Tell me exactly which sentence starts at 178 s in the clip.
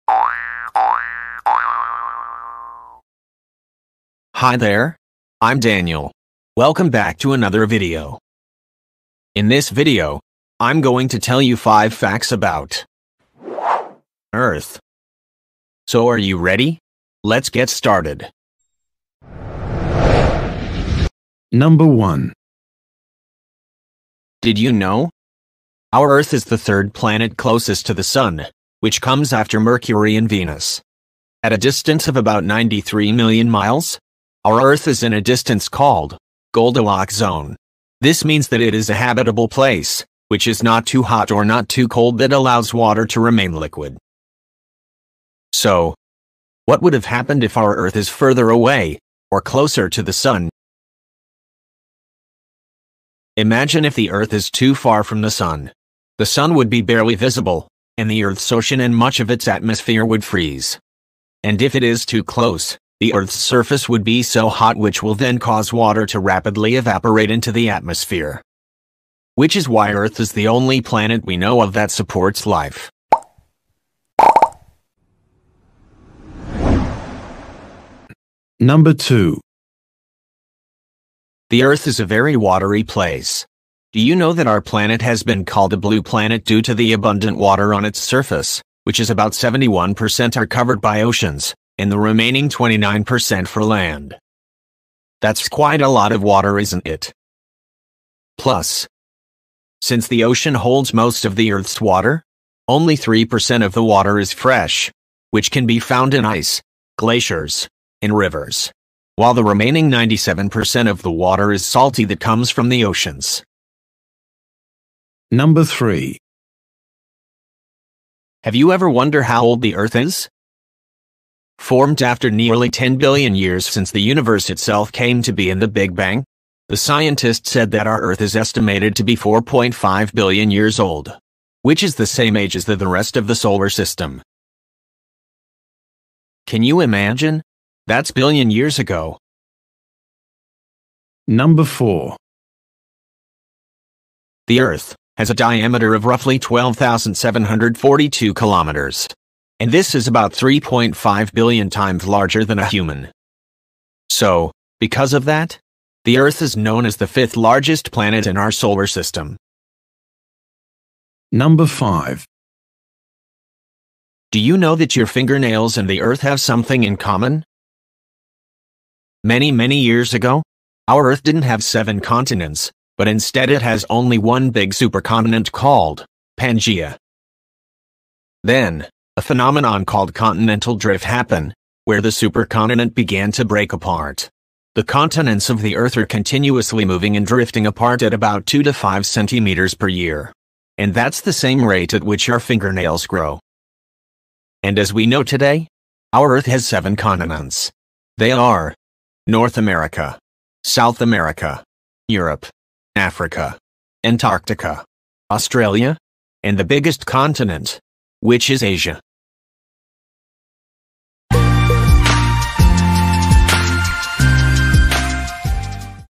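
Then, a phenomenon called continental drift happened, where the supercontinent began to break apart.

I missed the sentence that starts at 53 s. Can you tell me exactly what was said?
Imagine if the Earth is too far from the Sun.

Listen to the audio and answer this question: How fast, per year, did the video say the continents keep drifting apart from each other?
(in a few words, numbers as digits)
2 to 5 centimeters.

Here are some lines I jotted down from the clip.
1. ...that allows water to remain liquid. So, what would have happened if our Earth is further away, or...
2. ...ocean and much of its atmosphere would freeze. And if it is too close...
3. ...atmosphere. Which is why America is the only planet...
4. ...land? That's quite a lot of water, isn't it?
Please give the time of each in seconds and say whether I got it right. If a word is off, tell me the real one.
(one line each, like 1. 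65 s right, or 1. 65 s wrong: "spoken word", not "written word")
1. 42 s right
2. 58 s right
3. 67 s wrong: "Earth", not "America"
4. 93 s right.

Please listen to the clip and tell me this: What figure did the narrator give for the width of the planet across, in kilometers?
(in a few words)
12,742 kilometers.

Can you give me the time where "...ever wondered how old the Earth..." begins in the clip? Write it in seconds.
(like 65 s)
118 s.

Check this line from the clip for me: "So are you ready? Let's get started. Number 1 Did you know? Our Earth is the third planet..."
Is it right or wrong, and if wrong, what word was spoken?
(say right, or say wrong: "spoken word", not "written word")
right.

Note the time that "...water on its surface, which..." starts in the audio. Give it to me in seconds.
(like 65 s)
87 s.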